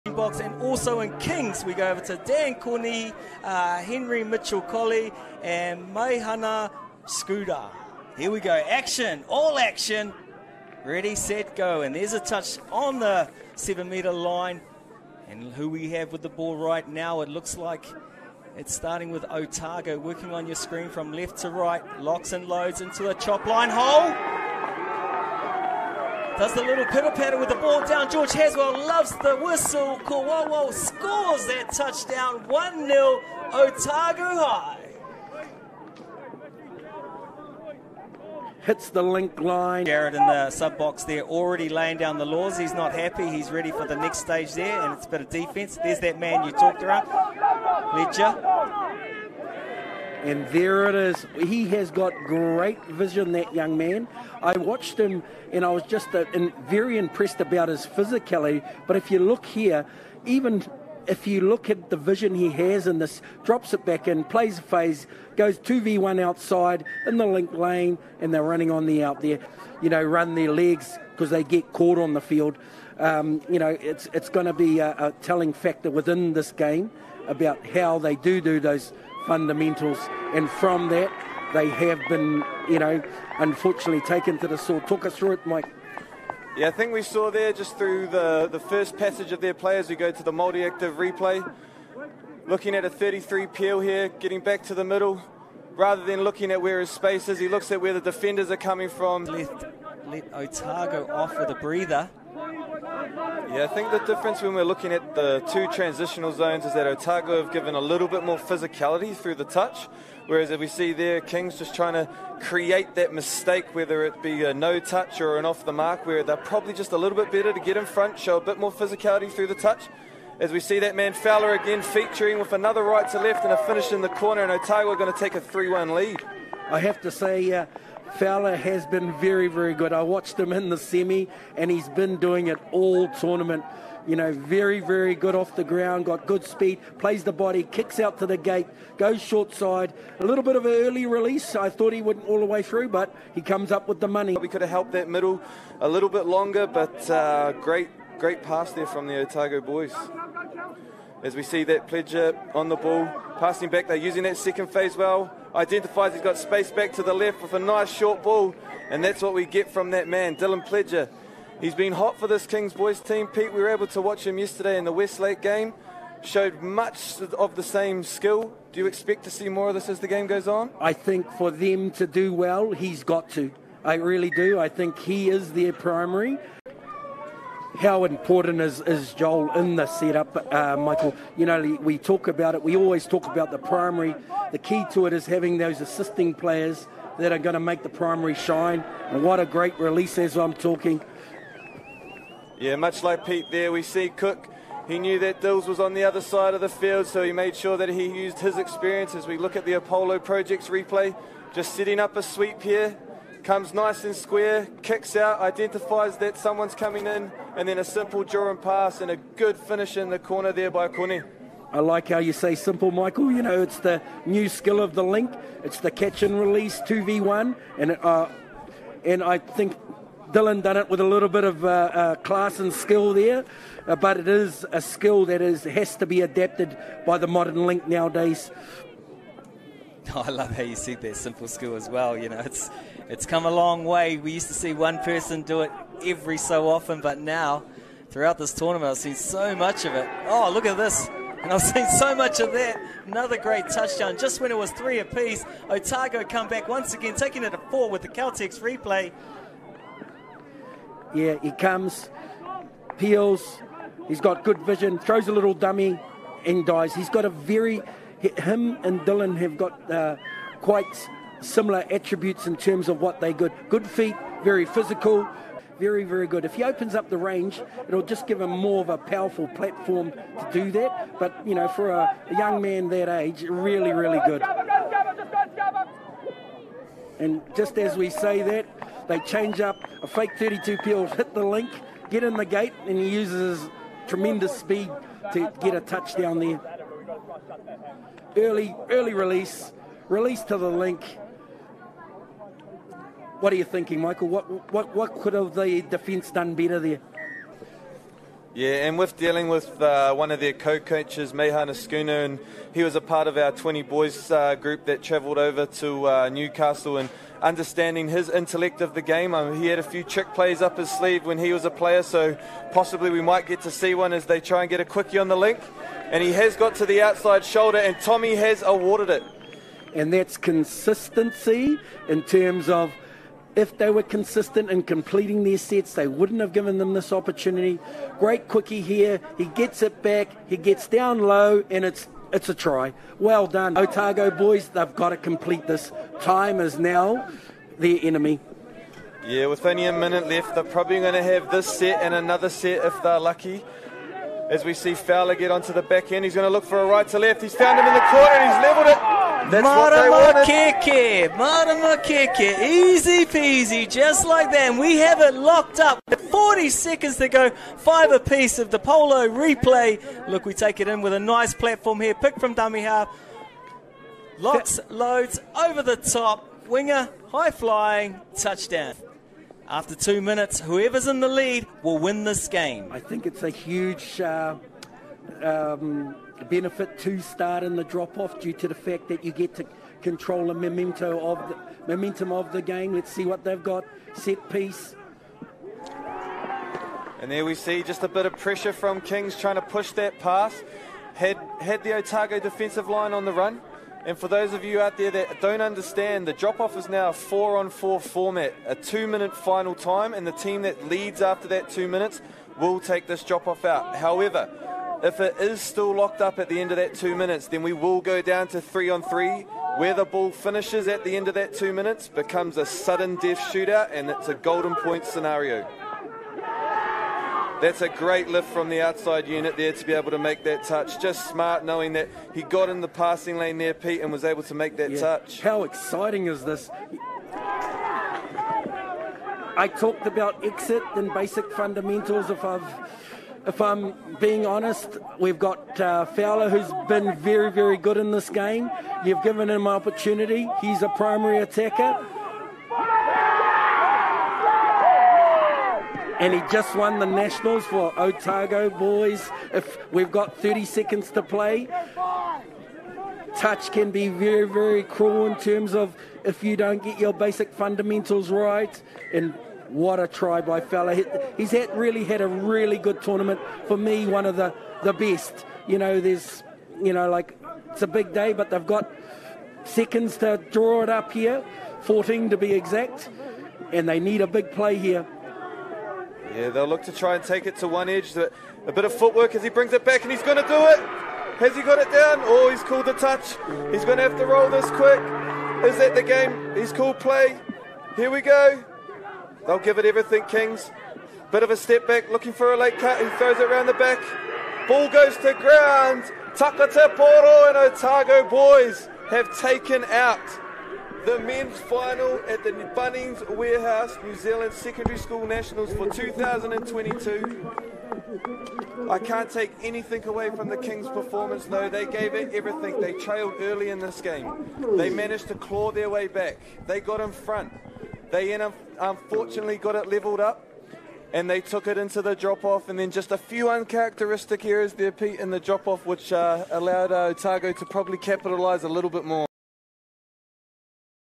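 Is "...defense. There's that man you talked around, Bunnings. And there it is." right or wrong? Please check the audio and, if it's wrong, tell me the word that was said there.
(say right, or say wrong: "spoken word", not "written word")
wrong: "Pledger", not "Bunnings".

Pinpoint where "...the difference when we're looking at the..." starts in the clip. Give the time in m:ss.
1:43.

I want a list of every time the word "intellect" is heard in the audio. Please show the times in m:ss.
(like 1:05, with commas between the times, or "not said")
5:08.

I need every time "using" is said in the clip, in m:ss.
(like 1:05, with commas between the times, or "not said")
2:33.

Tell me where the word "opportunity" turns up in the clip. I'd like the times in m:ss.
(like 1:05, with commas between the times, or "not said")
5:27, 7:19.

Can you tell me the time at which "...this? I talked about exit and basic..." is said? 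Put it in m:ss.
7:06.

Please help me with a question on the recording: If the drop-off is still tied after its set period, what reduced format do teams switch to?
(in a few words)
Three on three.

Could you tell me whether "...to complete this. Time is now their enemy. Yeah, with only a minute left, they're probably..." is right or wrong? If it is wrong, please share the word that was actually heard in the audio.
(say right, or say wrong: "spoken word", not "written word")
right.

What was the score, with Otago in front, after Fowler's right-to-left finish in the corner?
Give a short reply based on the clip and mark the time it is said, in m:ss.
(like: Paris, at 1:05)
3-1, at 2:05.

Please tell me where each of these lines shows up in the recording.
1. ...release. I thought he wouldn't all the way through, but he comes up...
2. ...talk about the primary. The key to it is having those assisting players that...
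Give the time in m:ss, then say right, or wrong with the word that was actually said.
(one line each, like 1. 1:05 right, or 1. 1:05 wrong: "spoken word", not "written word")
1. 2:21 right
2. 3:03 right.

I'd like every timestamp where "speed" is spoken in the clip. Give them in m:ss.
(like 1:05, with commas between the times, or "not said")
2:16, 4:44.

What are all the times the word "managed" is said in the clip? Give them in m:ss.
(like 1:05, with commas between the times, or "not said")
8:34.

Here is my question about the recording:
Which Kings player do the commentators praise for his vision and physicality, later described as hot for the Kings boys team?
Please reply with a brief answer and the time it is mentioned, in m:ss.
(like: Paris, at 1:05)
Dylan Pledger, at 2:40.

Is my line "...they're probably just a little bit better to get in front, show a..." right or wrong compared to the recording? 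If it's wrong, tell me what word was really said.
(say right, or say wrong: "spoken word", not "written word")
right.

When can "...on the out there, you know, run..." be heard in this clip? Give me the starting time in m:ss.
1:08.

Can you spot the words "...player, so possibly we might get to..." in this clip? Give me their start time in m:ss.
5:11.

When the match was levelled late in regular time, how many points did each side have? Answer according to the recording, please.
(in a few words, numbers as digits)
5.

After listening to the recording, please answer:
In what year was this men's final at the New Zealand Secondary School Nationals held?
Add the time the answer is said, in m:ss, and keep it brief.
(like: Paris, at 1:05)
2022, at 8:25.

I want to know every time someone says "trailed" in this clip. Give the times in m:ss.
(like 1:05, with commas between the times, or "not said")
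8:32.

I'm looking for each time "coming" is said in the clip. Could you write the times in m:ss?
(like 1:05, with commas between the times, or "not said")
1:38, 3:26.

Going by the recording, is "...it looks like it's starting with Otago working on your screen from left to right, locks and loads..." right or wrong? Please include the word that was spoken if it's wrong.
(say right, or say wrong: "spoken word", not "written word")
right.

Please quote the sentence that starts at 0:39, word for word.
Jared in the sub box there, already laying down the laws.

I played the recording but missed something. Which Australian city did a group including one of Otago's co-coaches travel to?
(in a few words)
Newcastle.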